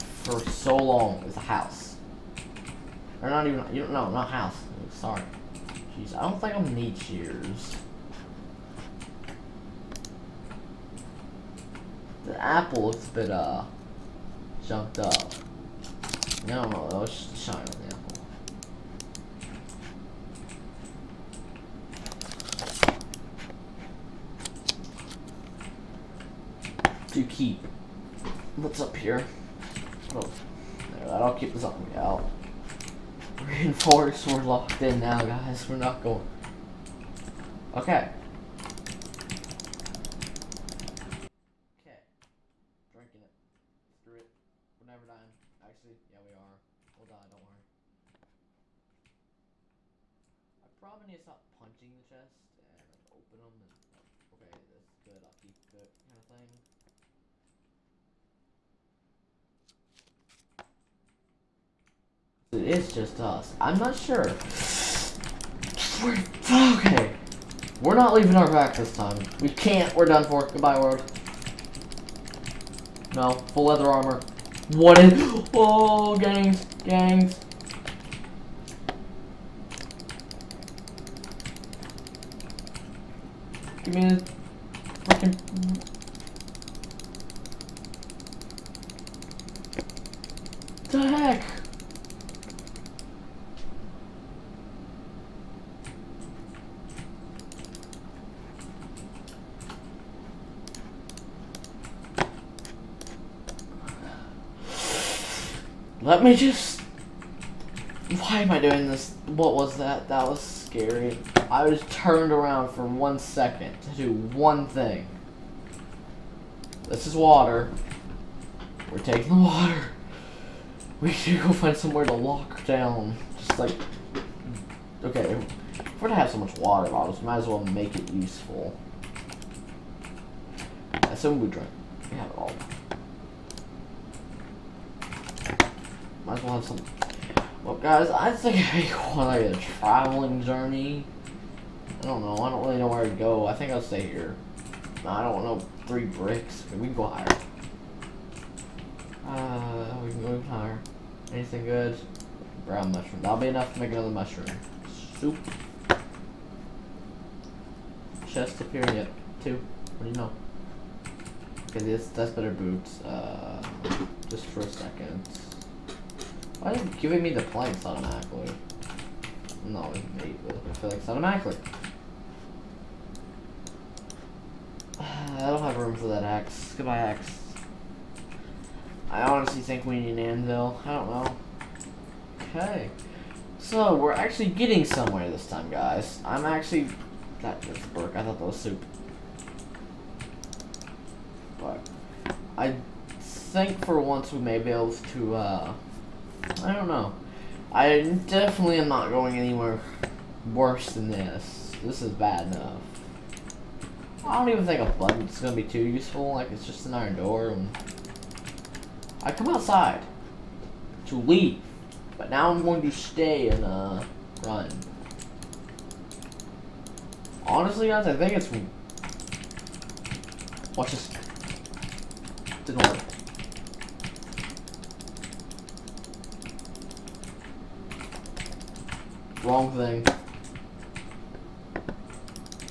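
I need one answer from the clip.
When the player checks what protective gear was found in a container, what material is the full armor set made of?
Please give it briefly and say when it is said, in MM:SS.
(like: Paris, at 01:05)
Leather, at 01:13.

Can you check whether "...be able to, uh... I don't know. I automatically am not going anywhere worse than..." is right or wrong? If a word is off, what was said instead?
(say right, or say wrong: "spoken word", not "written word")
wrong: "definitely", not "automatically".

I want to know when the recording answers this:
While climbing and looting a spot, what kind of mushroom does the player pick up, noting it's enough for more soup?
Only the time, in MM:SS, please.
02:32.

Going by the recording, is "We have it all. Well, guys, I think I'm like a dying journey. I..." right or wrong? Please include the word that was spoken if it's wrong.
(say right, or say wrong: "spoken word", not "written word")
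wrong: "traveling", not "dying".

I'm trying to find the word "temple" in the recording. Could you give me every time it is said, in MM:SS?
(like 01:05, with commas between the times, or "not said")
not said.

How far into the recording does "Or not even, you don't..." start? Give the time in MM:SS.
00:03.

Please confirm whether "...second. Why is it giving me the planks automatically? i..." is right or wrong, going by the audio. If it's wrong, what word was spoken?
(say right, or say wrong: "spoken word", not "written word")
right.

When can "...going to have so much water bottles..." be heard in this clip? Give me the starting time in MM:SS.
02:06.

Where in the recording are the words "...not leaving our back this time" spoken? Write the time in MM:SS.
01:07.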